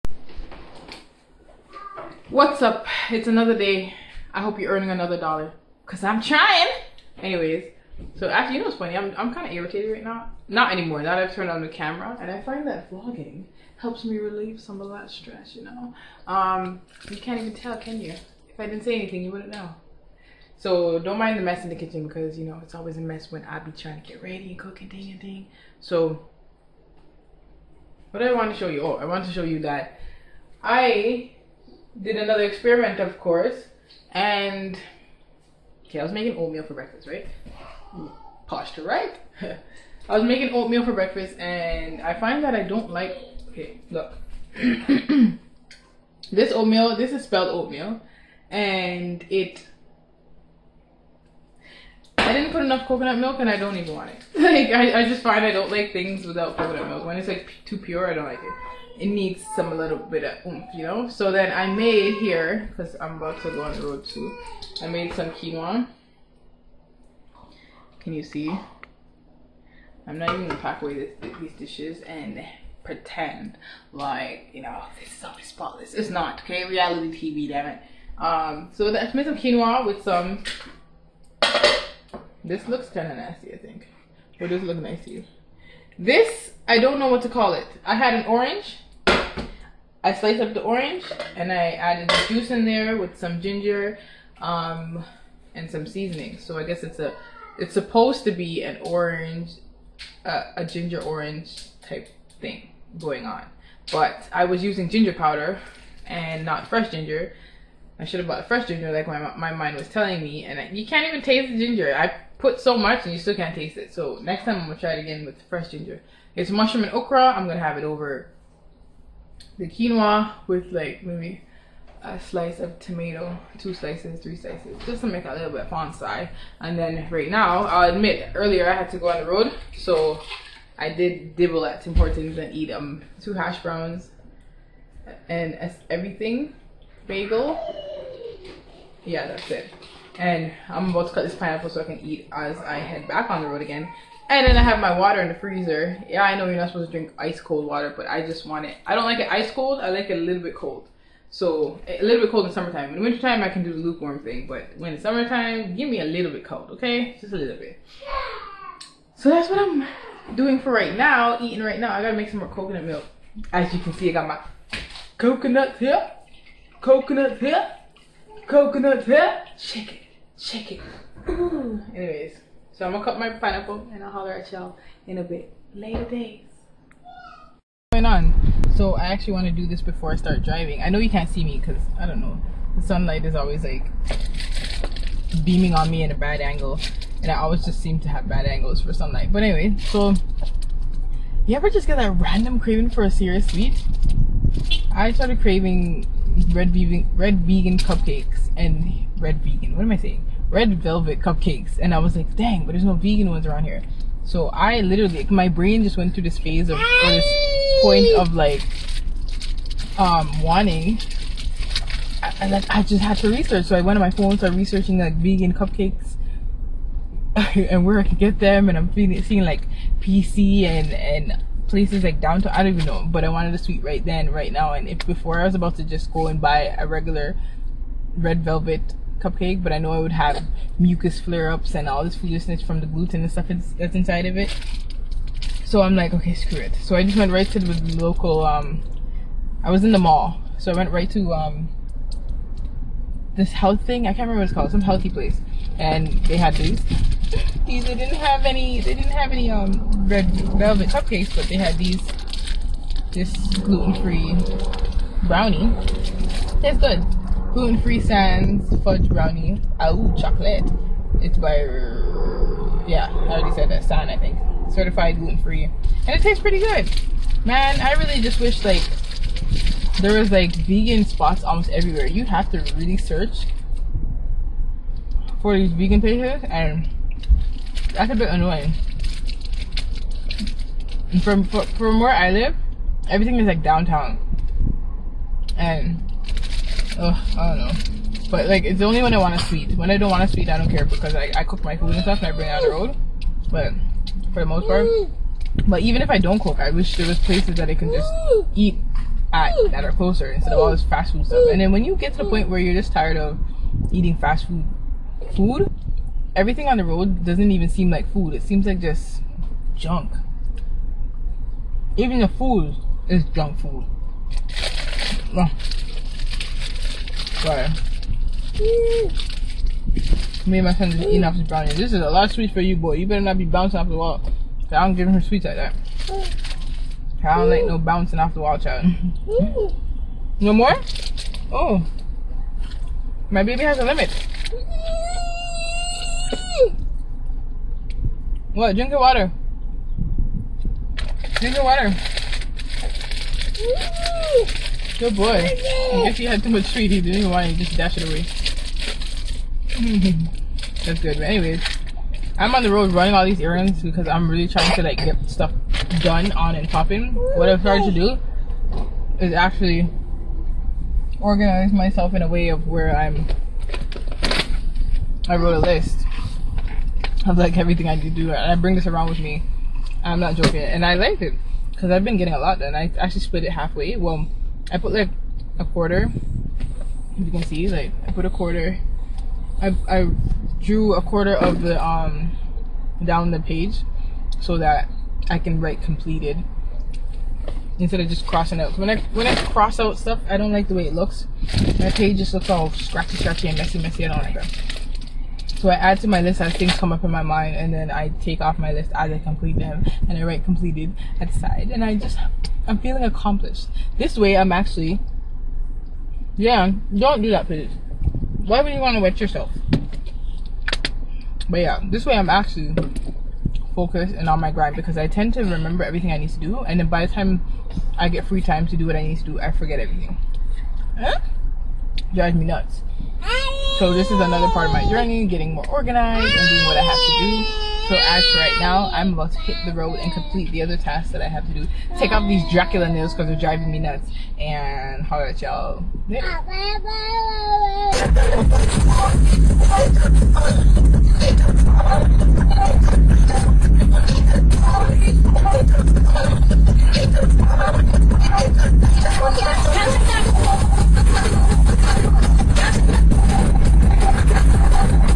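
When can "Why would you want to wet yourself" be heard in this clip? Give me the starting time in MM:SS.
06:48.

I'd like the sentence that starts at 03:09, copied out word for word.
But anyway, so you ever just get that random craving for a serious sweet?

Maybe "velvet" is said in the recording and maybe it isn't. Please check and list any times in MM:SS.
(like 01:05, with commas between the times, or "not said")
03:20, 03:48, 04:10.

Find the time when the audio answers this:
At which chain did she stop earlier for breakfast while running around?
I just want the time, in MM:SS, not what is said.
02:11.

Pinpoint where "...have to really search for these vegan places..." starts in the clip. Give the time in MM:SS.
04:32.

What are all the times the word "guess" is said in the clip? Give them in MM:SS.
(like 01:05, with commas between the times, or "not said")
01:36, 05:46.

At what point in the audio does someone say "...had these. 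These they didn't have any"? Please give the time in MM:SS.
04:06.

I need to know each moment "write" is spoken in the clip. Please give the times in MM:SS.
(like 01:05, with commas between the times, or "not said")
06:25, 06:40.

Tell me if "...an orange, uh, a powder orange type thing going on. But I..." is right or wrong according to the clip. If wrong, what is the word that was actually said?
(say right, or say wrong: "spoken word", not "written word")
wrong: "ginger", not "powder".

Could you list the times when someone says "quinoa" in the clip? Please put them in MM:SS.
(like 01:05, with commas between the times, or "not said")
01:05, 01:19, 01:59.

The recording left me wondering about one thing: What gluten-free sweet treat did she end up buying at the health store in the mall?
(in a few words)
fudge brownie.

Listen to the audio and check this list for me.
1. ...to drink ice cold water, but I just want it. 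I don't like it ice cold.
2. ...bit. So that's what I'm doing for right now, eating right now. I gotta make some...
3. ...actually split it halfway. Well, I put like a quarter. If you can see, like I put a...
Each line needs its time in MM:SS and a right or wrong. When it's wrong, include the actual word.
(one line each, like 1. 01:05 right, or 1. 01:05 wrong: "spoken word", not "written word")
1. 02:26 right
2. 02:37 right
3. 06:12 right.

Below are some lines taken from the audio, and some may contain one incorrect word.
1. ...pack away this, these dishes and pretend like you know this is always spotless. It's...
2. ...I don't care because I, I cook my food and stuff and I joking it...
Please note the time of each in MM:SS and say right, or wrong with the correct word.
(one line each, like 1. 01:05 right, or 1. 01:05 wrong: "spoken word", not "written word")
1. 01:10 right
2. 04:50 wrong: "bring", not "joking".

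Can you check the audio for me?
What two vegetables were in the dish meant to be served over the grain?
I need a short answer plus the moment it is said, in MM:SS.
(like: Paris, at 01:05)
mushroom and okra, at 01:56.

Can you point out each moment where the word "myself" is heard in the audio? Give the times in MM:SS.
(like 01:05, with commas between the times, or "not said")
06:01.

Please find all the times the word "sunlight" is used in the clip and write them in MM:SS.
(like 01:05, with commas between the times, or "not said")
03:02, 03:08.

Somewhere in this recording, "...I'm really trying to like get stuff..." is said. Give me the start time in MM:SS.
05:54.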